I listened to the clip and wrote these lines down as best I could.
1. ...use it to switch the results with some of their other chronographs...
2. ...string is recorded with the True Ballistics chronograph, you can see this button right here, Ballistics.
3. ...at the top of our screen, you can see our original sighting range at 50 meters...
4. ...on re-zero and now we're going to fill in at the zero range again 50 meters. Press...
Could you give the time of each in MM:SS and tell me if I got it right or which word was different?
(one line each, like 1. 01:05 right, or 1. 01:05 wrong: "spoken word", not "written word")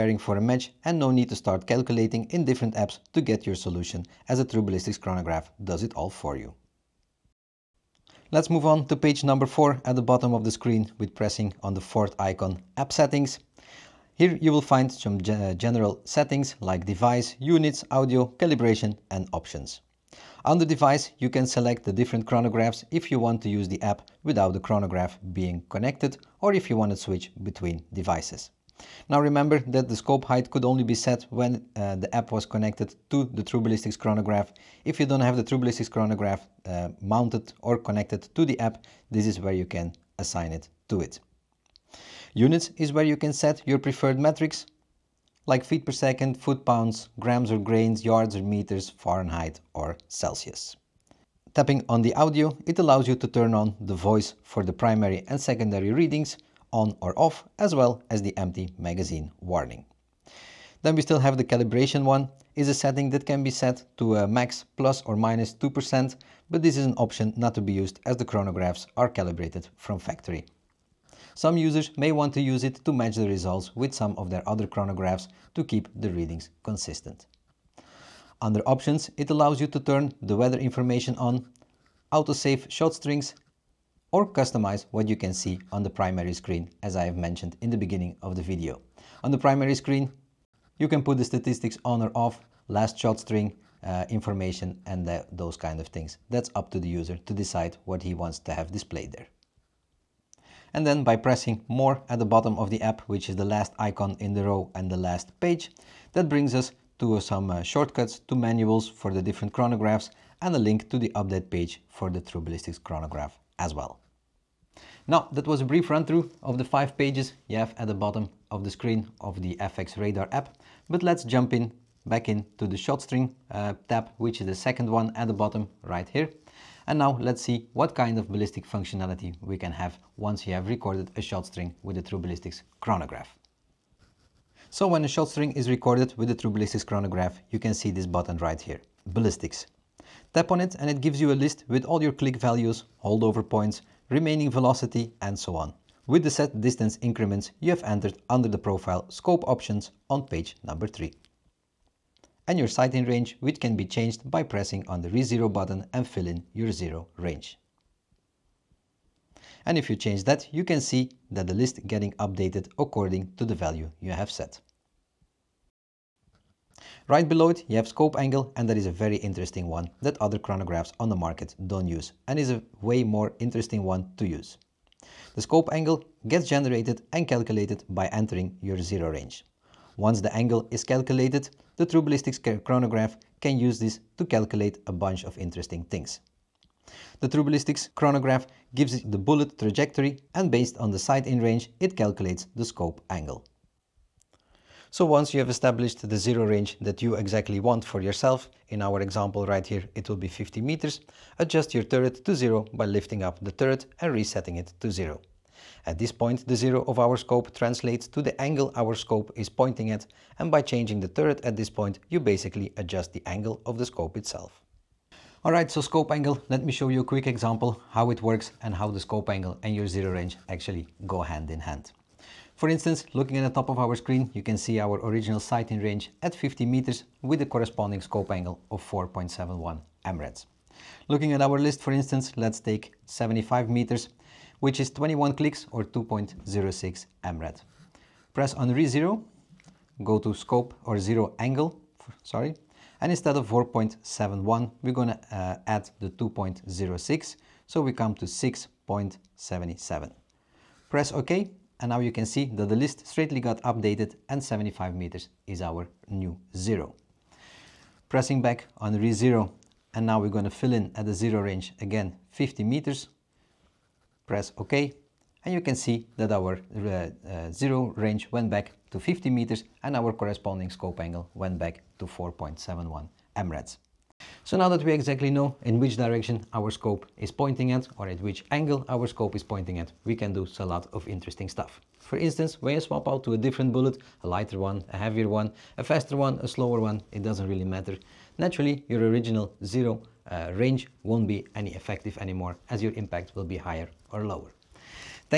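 1. 01:12 wrong: "match", not "switch"
2. 02:15 right
3. 03:43 right
4. 04:18 right.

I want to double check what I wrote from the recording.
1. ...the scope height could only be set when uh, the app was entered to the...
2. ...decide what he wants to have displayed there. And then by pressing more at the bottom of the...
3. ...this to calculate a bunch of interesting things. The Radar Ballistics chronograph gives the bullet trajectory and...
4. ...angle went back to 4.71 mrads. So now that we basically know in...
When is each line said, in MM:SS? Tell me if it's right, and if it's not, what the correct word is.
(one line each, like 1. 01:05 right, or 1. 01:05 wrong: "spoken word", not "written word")
1. 00:29 wrong: "connected", not "entered"
2. 01:37 right
3. 03:03 wrong: "True", not "Radar"
4. 04:30 wrong: "exactly", not "basically".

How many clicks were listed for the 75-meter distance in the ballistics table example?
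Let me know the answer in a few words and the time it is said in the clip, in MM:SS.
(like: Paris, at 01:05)
21, at 03:54.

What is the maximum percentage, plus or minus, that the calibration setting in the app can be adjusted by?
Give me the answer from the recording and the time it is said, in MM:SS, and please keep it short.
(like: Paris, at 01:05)
2%, at 01:05.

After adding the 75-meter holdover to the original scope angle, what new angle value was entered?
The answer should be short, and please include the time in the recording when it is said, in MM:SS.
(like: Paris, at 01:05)
6.77, at 04:08.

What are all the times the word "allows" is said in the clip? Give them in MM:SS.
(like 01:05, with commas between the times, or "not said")
00:52, 01:19.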